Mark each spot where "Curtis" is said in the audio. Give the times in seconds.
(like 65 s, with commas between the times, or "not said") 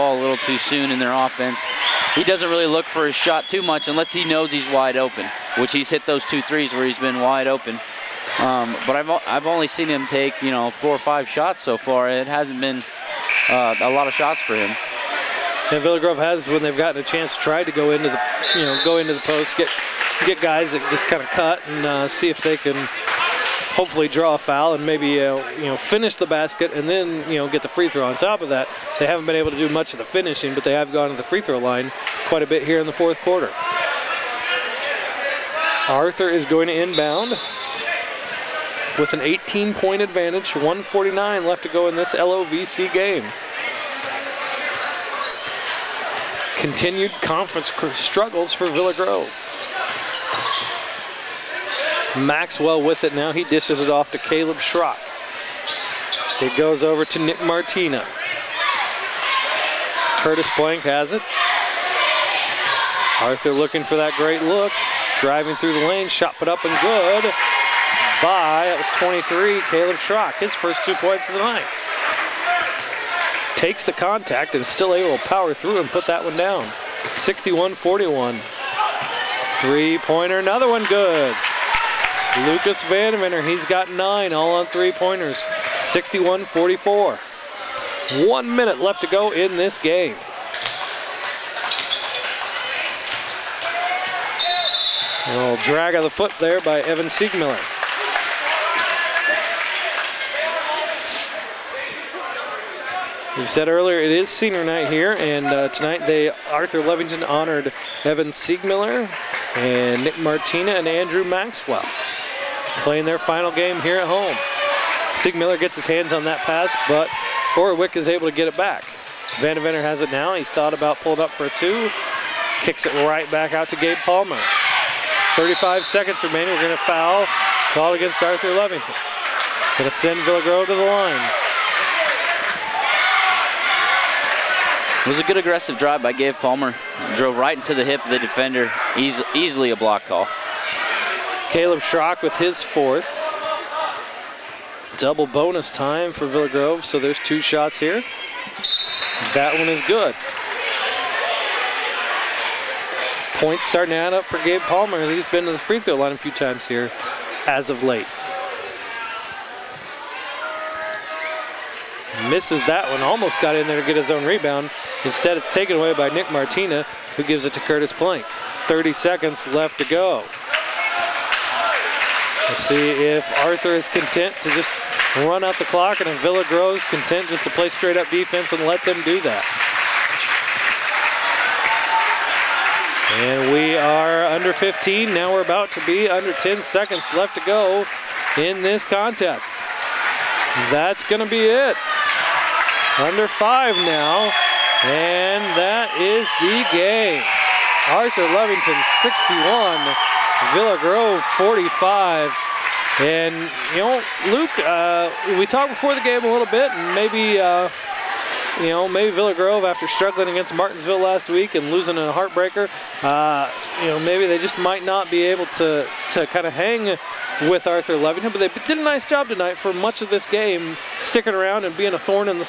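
60 s, 167 s.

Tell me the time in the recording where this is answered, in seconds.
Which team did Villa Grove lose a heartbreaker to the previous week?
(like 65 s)
210 s.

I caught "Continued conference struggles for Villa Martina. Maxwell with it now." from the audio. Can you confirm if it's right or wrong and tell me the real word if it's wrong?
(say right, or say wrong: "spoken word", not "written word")
wrong: "Grove", not "Martina".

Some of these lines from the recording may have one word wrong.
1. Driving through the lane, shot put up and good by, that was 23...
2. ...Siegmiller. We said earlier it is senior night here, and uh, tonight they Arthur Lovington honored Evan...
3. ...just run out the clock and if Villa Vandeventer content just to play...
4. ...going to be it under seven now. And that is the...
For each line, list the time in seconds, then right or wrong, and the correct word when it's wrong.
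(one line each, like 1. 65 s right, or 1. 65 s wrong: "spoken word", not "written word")
1. 65 s right
2. 97 s right
3. 174 s wrong: "Groves", not "Vandeventer"
4. 191 s wrong: "five", not "seven".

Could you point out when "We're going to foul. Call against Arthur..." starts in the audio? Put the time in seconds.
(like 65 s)
126 s.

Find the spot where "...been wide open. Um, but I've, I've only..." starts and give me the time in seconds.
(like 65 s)
6 s.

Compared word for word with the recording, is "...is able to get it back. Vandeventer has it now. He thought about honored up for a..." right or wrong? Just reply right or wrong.
wrong.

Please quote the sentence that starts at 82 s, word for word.
Lucas Vandeventer, he's got nine, all on three-pointers, 61-44.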